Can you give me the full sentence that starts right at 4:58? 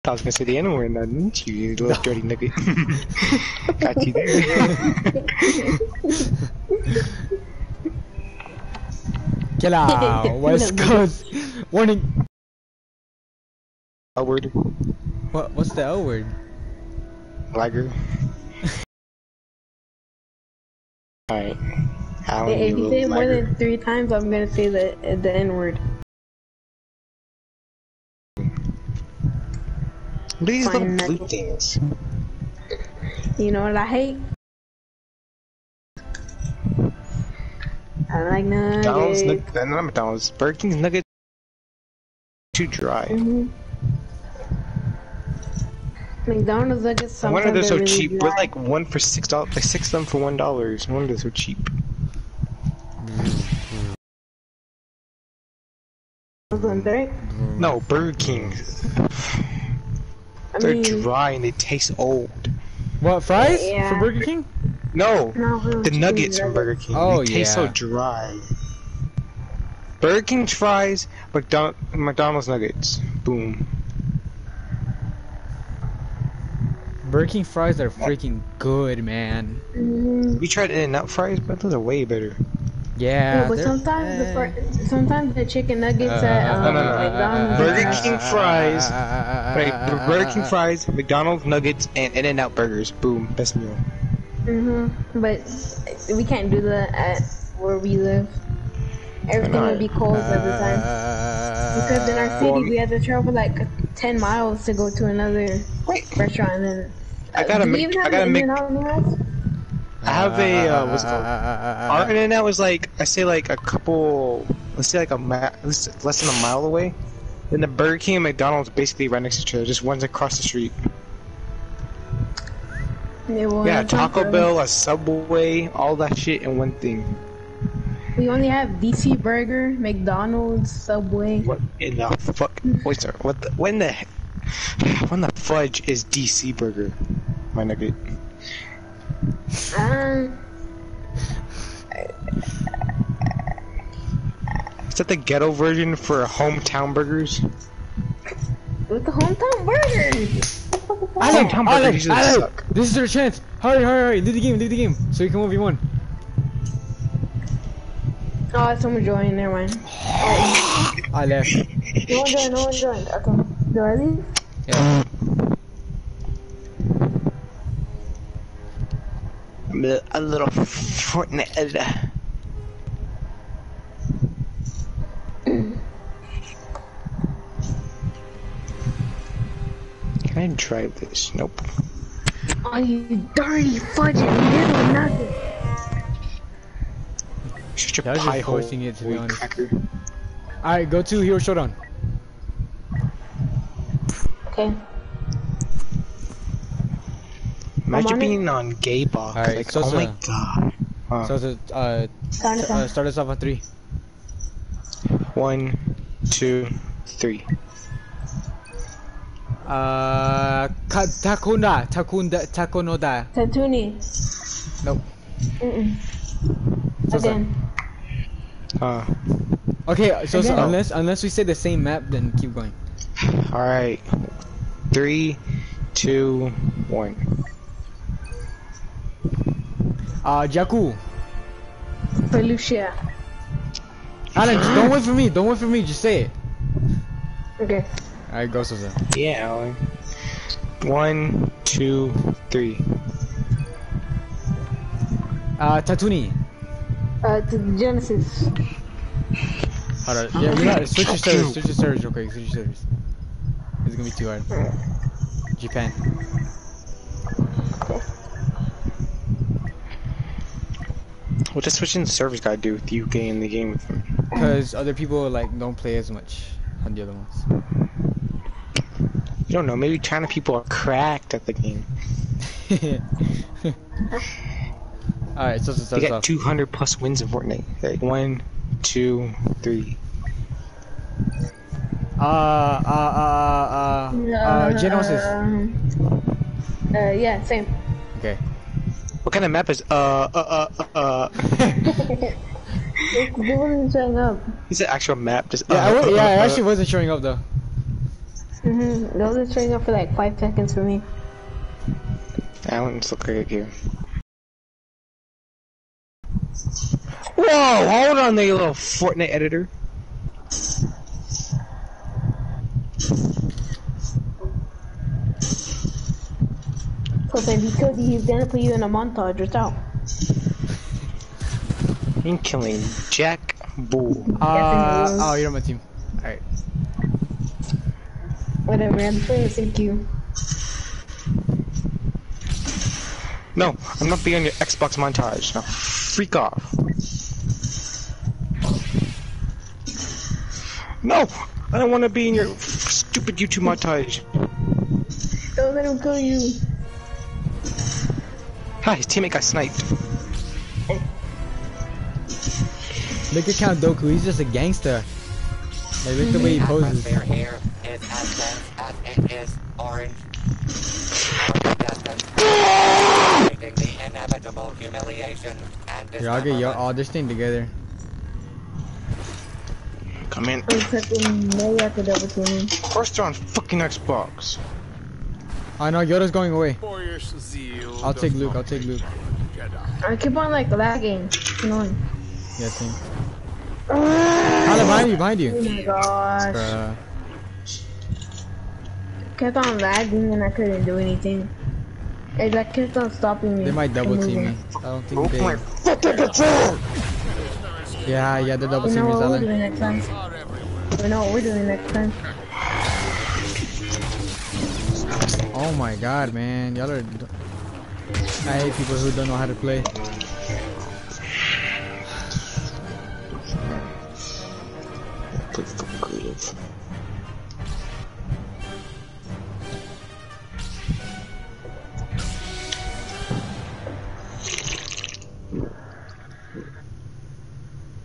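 Mhm, it wasn't showing up for like five seconds for me.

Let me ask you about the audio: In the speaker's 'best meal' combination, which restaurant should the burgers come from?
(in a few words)
In-N-Out.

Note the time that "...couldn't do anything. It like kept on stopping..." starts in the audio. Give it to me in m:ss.
6:30.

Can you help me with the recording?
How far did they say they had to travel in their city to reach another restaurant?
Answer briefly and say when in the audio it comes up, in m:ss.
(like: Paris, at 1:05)
10 miles, at 1:43.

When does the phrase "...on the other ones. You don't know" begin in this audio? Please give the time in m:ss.
4:26.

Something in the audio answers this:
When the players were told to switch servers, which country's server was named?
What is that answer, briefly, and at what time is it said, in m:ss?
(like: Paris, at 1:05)
Japan, at 4:15.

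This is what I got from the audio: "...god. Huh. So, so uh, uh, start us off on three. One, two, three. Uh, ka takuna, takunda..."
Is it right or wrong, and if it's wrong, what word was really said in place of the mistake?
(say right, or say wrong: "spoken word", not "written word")
right.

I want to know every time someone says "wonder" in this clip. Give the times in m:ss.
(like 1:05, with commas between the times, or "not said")
0:50.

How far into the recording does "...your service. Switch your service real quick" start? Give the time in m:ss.
4:11.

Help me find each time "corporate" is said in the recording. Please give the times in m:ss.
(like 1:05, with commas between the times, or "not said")
not said.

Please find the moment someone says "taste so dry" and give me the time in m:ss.
1:07.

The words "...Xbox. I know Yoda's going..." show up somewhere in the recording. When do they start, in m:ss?
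6:13.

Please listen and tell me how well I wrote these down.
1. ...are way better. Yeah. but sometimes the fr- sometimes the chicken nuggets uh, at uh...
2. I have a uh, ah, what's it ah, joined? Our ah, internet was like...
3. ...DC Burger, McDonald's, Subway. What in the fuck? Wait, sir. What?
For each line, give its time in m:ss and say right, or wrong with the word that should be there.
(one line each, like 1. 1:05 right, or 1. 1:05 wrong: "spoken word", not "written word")
1. 1:21 right
2. 1:50 wrong: "called", not "joined"
3. 2:08 right.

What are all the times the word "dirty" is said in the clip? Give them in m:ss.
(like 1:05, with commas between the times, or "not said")
0:02, 3:03.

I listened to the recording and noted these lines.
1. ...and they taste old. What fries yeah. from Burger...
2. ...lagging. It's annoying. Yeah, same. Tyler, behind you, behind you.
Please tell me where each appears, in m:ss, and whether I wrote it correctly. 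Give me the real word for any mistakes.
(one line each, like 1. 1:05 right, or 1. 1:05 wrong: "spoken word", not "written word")
1. 1:01 right
2. 6:20 right.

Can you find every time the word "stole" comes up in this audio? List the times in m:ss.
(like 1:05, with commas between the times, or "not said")
not said.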